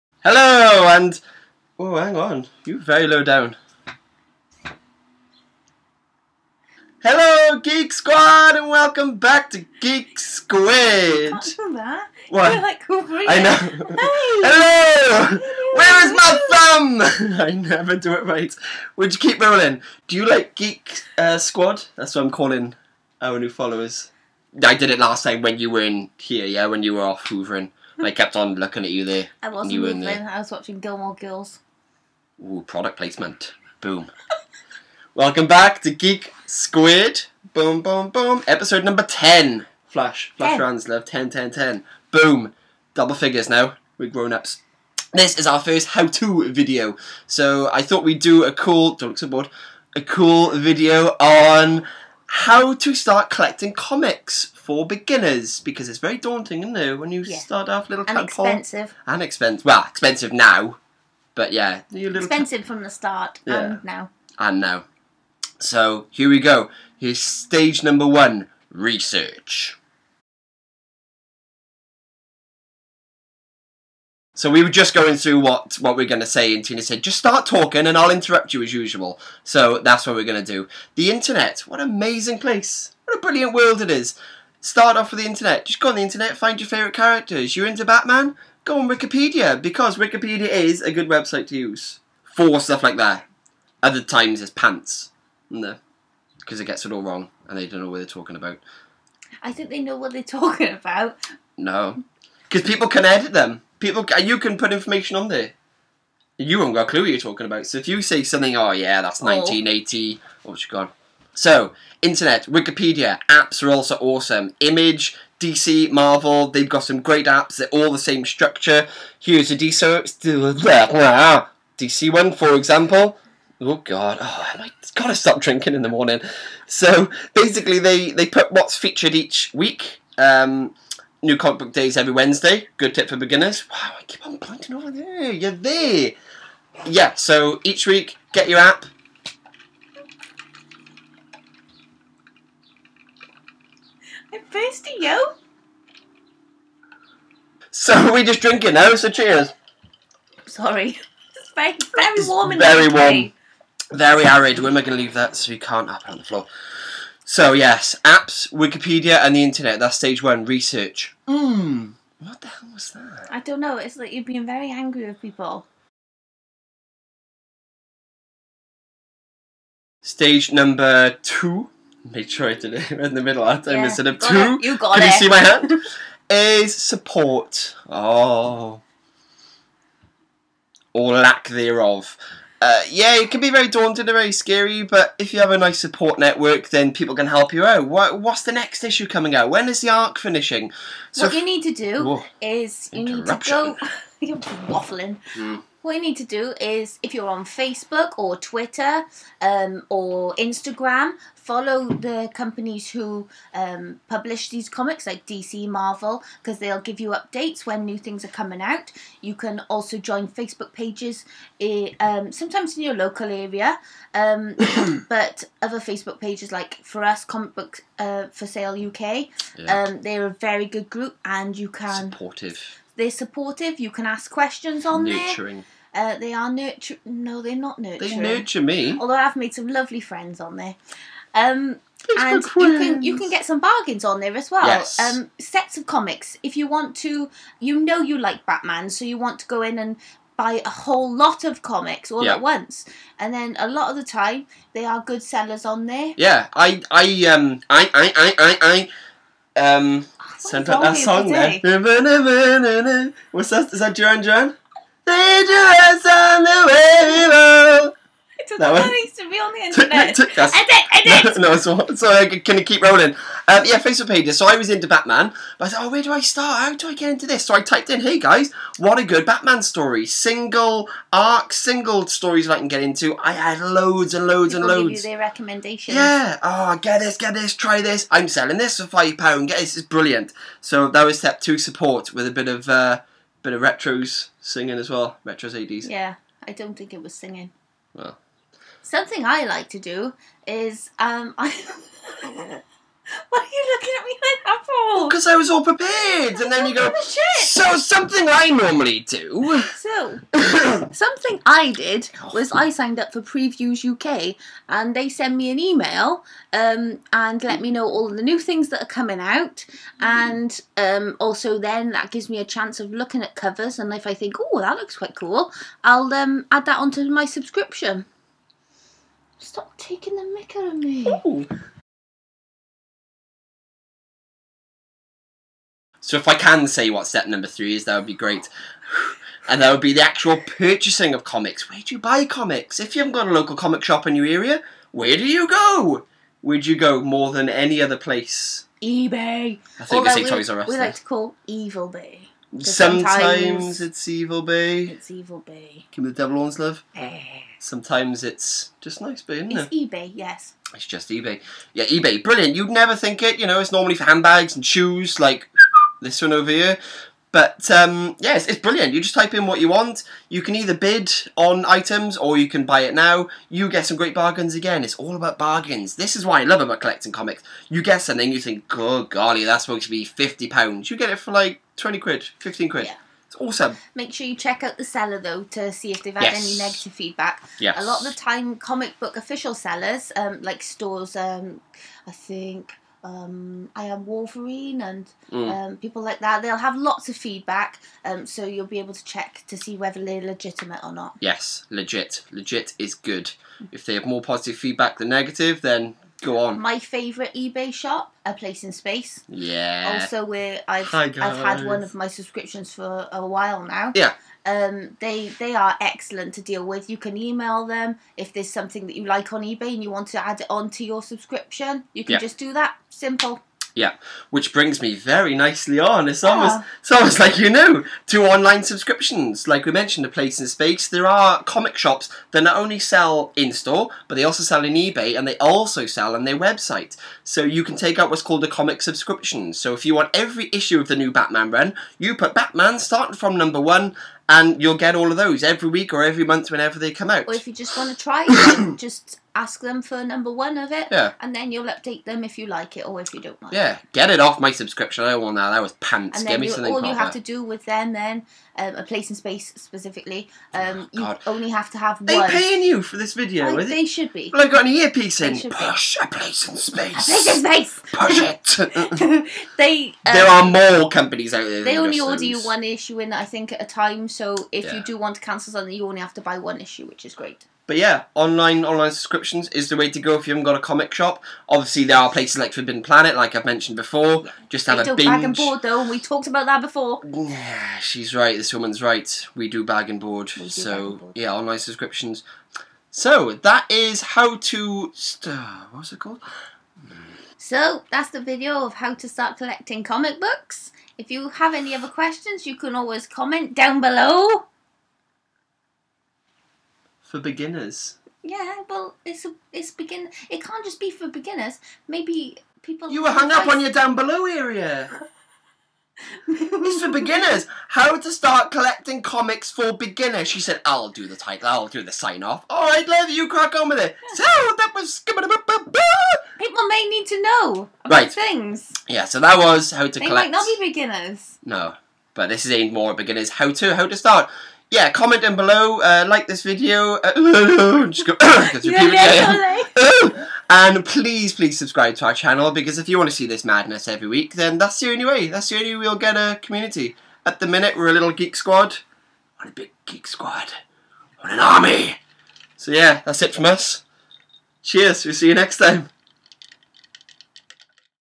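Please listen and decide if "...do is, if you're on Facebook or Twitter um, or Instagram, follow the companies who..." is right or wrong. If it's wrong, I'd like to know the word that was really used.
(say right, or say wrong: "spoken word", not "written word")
right.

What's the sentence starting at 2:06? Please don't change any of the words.
So basically, they they put what's featured each week.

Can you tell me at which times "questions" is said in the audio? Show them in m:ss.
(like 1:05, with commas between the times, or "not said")
3:44, 8:11.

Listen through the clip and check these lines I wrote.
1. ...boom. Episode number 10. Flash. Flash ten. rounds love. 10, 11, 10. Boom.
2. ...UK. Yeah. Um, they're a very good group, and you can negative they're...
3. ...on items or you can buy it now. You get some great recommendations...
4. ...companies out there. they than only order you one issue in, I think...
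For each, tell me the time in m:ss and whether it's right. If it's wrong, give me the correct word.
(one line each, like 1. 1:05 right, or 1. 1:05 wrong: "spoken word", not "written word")
1. 0:38 wrong: "10", not "11"
2. 3:38 wrong: "supportive", not "negative"
3. 6:01 wrong: "bargains", not "recommendations"
4. 7:40 right.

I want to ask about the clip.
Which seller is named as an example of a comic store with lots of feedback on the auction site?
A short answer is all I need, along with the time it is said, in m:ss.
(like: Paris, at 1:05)
I am Wolverine, at 6:23.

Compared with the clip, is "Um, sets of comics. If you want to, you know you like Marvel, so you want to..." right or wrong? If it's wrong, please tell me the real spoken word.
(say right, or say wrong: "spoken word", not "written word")
wrong: "Batman", not "Marvel".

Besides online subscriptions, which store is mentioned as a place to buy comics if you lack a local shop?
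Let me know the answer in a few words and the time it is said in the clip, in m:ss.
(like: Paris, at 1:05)
Forbidden Planet, at 7:52.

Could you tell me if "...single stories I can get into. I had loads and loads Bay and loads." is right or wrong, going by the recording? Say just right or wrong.
wrong.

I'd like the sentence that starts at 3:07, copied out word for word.
What, what's the next issue coming out?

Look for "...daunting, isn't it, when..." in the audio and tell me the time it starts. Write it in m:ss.
0:56.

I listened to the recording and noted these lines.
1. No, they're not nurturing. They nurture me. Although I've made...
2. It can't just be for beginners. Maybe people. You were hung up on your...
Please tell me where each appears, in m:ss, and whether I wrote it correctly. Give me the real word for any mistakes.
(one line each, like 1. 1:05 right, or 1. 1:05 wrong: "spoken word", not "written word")
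1. 3:47 right
2. 8:20 right.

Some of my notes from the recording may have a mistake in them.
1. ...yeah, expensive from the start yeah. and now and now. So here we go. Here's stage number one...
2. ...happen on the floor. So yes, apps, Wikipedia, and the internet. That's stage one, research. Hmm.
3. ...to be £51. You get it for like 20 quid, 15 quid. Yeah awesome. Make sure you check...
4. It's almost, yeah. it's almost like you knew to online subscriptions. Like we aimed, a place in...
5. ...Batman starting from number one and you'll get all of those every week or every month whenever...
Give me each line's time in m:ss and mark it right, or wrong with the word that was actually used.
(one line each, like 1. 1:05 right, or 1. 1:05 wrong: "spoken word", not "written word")
1. 1:01 right
2. 2:35 right
3. 6:09 wrong: "50", not "51"
4. 6:56 wrong: "mentioned", not "aimed"
5. 7:12 right.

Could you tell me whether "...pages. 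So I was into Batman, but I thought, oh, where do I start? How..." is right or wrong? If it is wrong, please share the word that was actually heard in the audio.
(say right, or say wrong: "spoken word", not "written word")
right.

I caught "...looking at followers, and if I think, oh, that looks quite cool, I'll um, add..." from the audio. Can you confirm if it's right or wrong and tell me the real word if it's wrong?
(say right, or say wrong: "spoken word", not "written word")
wrong: "covers", not "followers".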